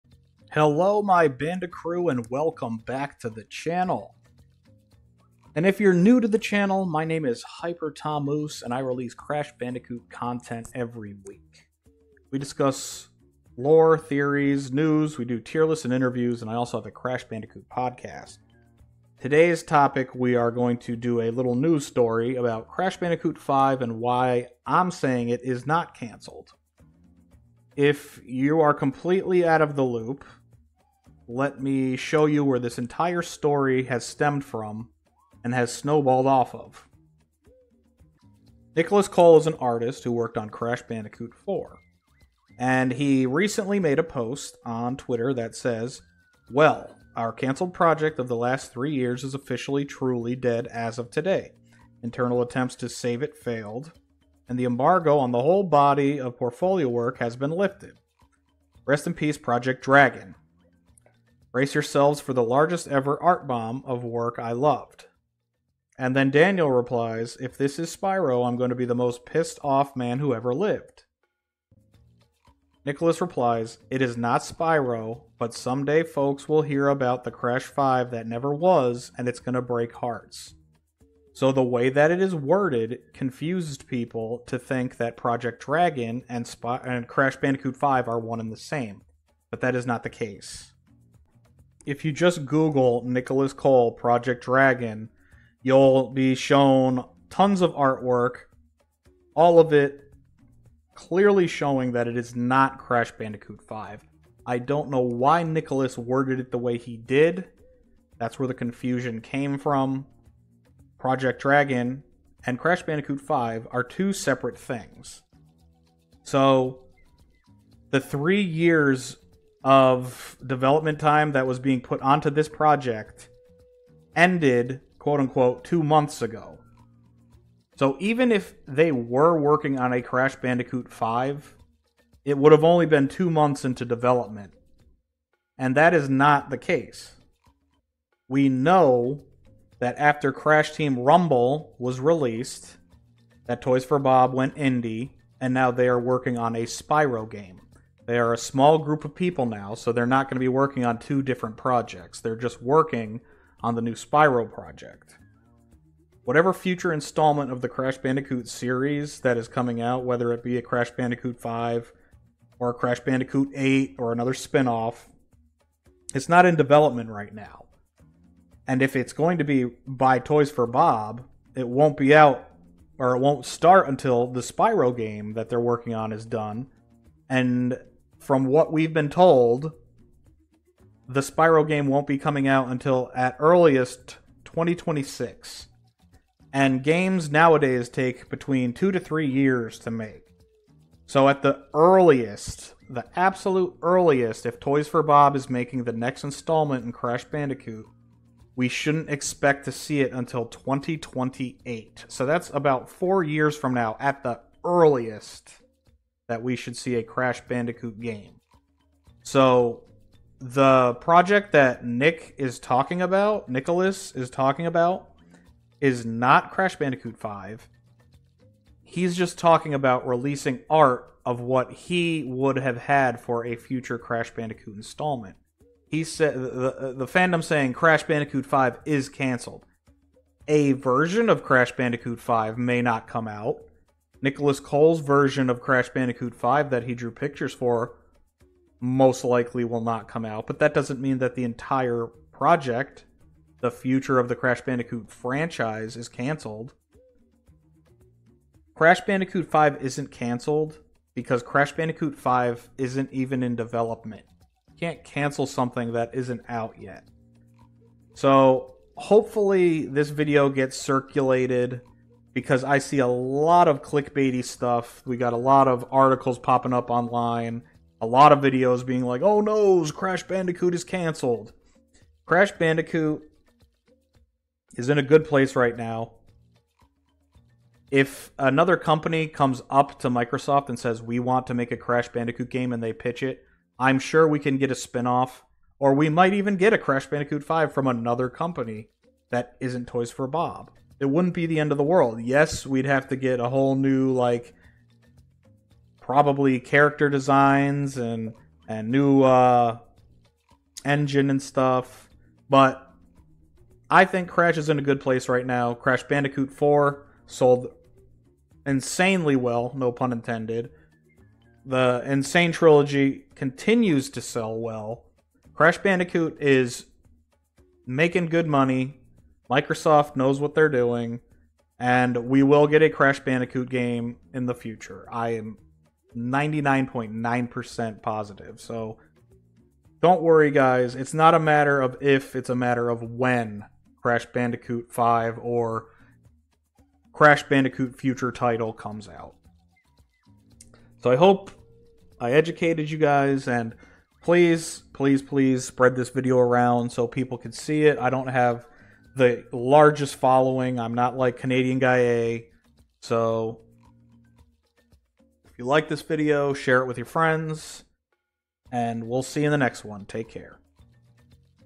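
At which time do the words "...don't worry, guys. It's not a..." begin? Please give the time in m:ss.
5:30.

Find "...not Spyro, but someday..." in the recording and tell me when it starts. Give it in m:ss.
1:14.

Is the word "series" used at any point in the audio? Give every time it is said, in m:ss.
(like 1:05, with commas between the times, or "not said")
2:38.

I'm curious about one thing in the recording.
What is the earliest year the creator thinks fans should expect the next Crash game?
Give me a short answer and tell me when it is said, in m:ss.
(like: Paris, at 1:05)
2028, at 3:20.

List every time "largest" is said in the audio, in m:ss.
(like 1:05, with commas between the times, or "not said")
1:02, 5:49.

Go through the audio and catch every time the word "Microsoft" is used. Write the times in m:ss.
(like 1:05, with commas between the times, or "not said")
4:40, 5:19.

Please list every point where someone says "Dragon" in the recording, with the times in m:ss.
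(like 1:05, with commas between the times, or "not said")
0:59, 1:25, 1:34, 1:51.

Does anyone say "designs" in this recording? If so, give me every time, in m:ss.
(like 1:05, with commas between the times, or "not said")
4:57.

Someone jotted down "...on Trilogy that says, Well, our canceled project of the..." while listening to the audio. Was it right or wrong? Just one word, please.
wrong.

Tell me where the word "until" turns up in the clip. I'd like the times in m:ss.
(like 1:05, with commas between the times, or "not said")
2:53, 3:02, 3:20.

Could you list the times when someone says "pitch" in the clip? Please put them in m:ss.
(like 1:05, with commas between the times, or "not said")
4:42.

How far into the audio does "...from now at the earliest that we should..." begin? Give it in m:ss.
3:23.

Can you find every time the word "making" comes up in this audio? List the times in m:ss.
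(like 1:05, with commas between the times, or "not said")
3:15, 5:17.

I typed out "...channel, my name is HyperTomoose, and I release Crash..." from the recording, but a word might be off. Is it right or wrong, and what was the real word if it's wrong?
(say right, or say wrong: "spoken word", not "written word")
right.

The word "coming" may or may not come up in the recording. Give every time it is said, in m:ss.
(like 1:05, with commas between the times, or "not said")
2:39, 3:02.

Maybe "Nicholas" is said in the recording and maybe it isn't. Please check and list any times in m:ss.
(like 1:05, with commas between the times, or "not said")
0:38, 1:12, 1:33, 1:45, 3:33, 3:54.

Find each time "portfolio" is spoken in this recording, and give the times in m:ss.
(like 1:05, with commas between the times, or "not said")
0:56.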